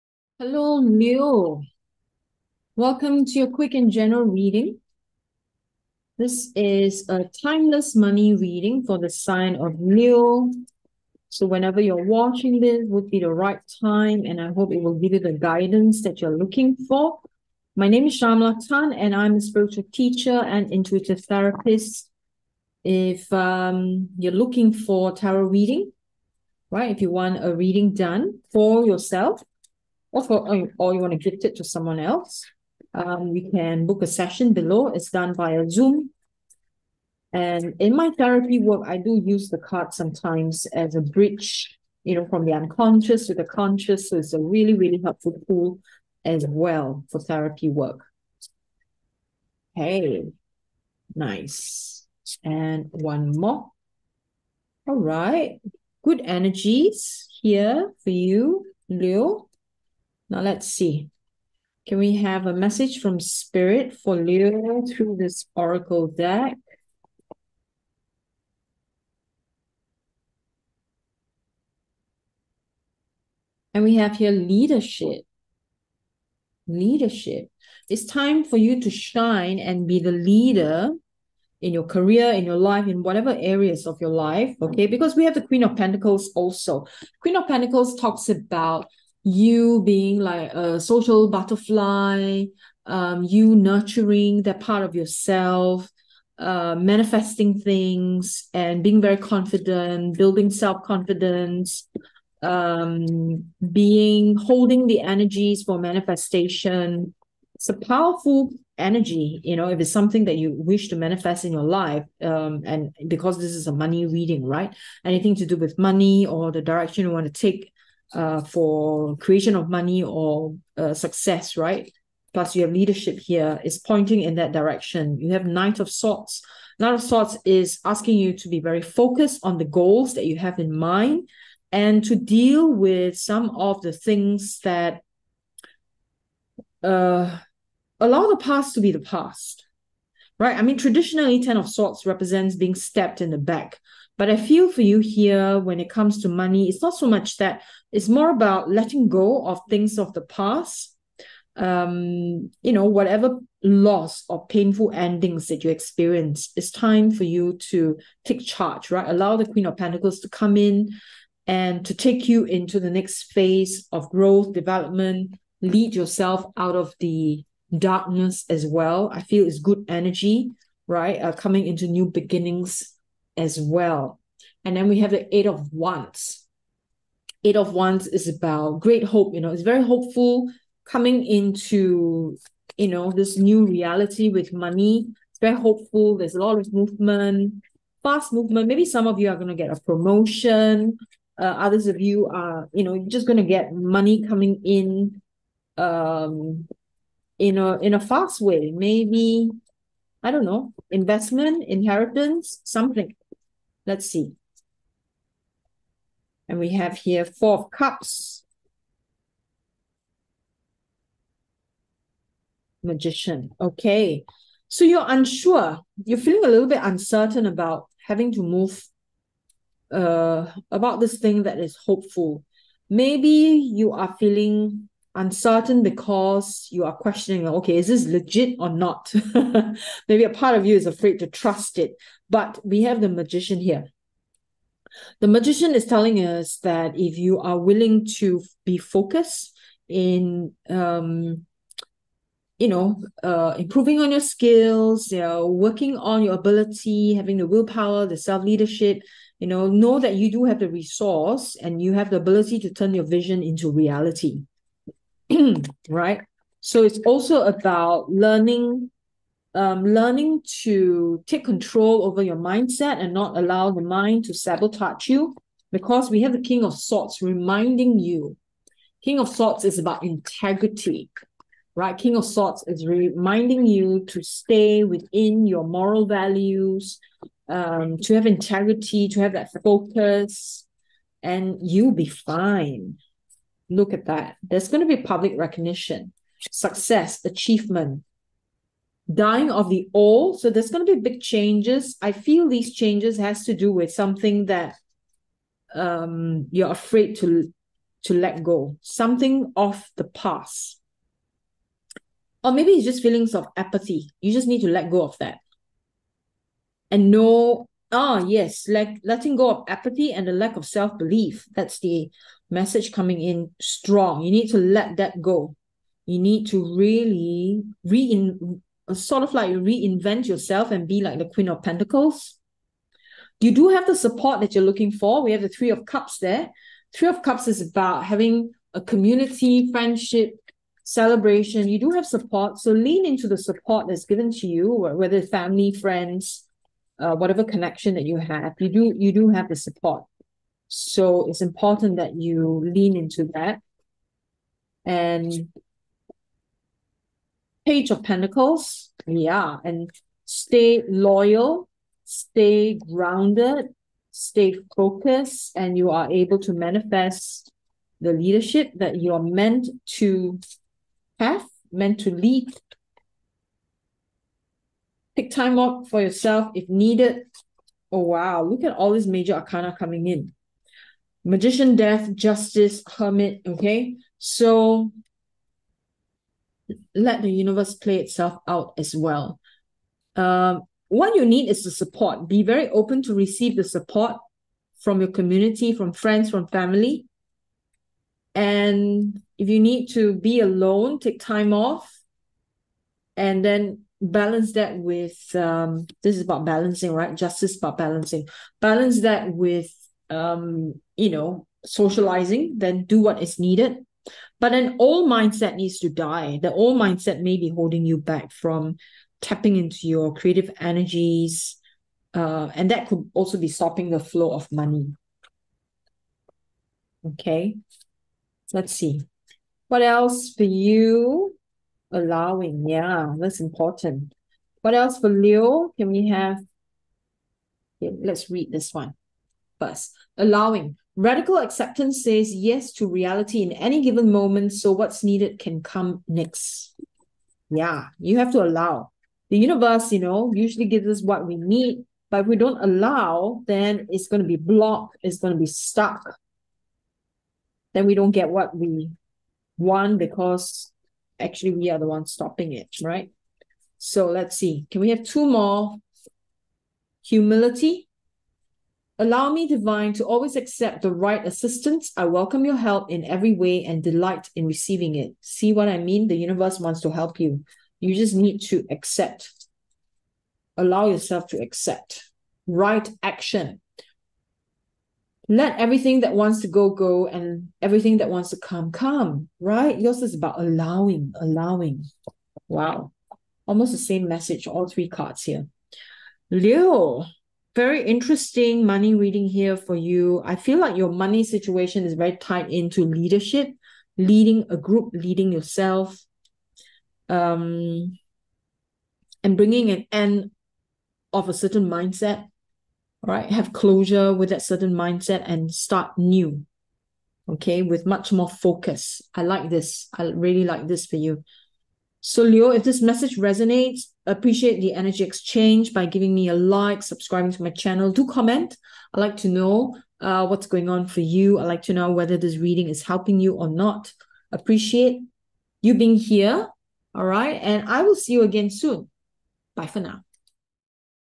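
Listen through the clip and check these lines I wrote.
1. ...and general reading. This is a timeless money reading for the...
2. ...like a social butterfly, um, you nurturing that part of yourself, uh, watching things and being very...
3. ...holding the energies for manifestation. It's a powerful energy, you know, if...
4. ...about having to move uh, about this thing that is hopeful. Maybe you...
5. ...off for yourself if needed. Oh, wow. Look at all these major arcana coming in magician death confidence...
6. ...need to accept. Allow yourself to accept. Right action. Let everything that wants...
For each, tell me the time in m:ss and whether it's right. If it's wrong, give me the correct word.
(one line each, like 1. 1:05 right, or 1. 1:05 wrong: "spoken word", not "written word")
1. 0:03 right
2. 1:30 wrong: "manifesting", not "watching"
3. 1:44 right
4. 3:37 right
5. 6:05 wrong: "justice", not "confidence"
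6. 7:48 right.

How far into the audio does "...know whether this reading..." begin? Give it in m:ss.
8:41.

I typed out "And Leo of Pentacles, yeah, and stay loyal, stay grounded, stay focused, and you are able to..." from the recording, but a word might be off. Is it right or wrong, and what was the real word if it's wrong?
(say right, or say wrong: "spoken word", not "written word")
wrong: "Page", not "Leo".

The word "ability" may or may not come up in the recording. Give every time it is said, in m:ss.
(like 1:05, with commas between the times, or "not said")
4:06, 4:12.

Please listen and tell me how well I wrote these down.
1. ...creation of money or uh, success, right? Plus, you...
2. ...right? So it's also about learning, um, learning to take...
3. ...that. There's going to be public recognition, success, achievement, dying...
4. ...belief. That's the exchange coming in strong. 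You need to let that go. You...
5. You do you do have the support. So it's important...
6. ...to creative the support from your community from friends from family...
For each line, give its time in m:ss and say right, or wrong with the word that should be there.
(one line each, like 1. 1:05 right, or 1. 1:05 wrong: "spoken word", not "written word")
1. 1:59 right
2. 4:15 right
3. 4:44 right
4. 5:10 wrong: "message", not "exchange"
5. 5:38 right
6. 6:23 wrong: "receive", not "creative".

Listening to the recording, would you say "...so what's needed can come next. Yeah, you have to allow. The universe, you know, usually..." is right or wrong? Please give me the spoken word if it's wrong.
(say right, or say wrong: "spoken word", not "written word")
right.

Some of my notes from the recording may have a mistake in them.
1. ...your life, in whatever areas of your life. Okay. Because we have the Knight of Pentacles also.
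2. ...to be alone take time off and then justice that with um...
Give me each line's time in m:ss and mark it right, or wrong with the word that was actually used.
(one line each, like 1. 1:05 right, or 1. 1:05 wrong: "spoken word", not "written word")
1. 1:22 wrong: "Queen", not "Knight"
2. 6:29 wrong: "balance", not "justice".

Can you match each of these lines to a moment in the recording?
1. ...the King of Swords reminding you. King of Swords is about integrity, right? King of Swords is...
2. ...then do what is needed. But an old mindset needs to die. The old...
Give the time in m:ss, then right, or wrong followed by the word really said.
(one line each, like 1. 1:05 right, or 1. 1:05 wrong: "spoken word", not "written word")
1. 4:26 right
2. 6:42 right.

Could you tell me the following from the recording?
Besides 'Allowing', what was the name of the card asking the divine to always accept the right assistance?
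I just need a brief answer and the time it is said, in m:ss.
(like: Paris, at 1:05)
Humility, at 7:37.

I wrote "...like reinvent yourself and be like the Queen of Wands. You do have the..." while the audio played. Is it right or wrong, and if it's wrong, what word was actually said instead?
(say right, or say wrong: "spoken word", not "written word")
wrong: "Pentacles", not "Wands".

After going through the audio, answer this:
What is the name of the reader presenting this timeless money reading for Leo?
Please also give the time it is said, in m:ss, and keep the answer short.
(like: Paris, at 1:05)
Shamala Tan, at 0:18.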